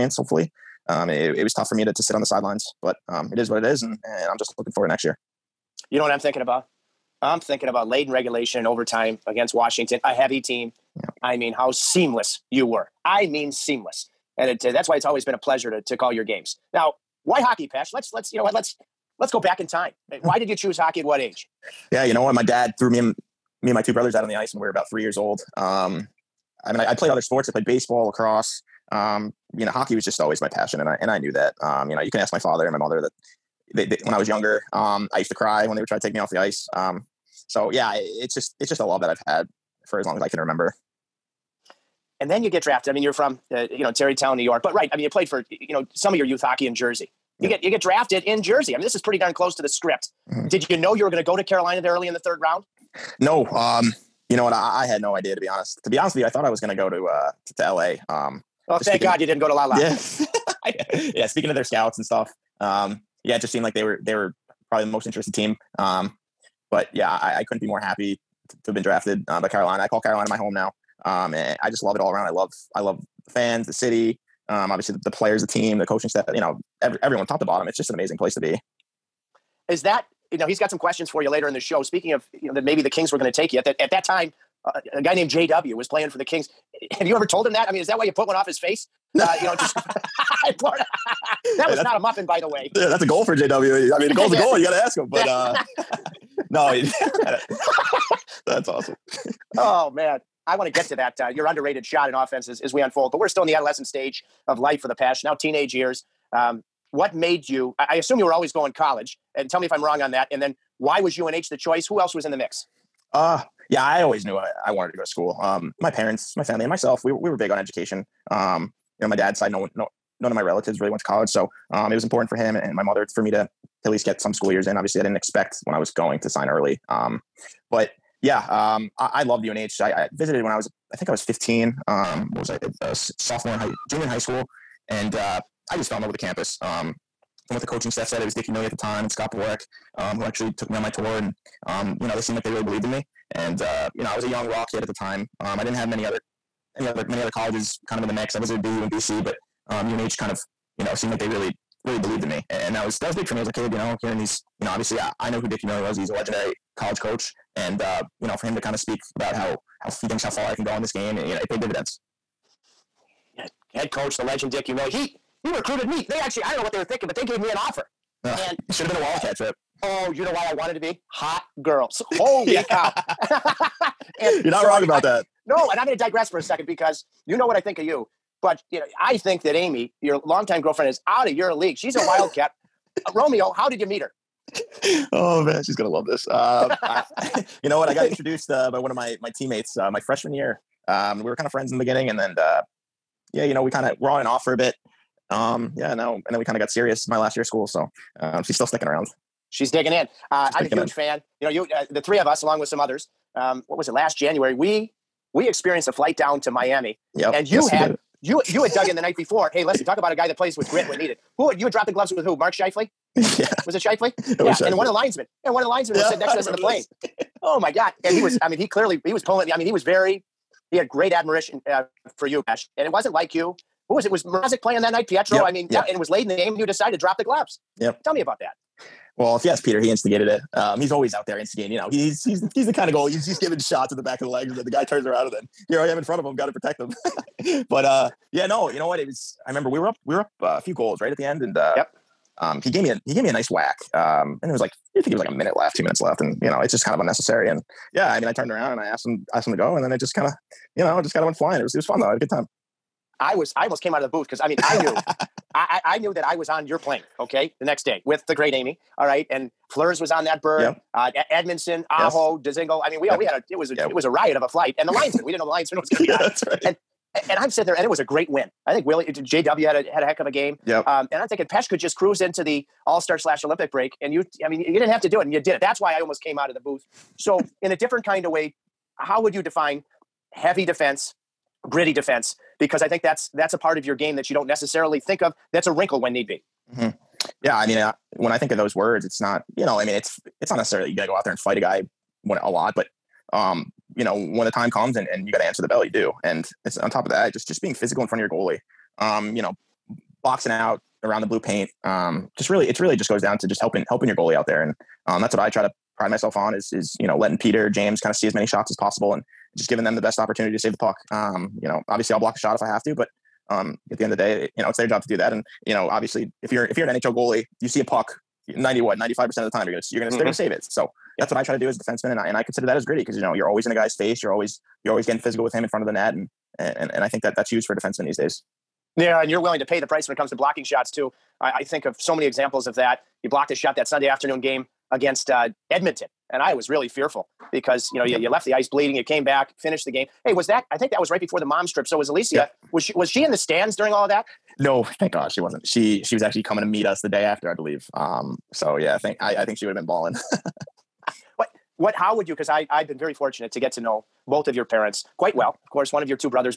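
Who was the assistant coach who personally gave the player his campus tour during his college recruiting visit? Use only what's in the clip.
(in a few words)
Scott Borek.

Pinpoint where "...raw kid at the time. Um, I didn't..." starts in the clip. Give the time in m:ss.
2:24.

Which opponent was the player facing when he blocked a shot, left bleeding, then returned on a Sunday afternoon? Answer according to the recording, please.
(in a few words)
Edmonton.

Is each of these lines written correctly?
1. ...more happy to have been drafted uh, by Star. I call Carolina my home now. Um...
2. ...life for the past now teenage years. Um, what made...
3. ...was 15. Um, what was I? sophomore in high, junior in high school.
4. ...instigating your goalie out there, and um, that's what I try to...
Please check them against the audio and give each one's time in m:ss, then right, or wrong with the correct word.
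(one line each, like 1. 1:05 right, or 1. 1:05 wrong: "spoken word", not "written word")
1. 1:07 wrong: "Carolina", not "Star"
2. 1:44 right
3. 2:11 right
4. 5:03 wrong: "helping", not "instigating".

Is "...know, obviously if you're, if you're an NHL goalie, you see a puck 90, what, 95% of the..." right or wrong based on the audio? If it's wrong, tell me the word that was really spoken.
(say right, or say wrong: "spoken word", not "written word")
right.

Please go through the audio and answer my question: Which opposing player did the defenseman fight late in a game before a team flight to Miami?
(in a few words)
Mark Scheifele.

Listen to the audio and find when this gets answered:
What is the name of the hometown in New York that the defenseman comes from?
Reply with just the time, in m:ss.
0:43.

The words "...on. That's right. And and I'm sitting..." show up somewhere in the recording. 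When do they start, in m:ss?
4:26.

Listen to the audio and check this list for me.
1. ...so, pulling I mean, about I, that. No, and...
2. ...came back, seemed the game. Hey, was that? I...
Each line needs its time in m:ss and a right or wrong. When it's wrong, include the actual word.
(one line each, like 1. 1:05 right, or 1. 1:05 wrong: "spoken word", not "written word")
1. 2:54 wrong: "wrong", not "pulling"
2. 5:39 wrong: "finished", not "seemed".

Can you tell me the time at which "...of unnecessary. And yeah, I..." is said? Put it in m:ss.
4:06.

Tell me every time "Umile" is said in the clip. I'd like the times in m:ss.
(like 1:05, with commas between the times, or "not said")
2:18, 2:35, 2:44.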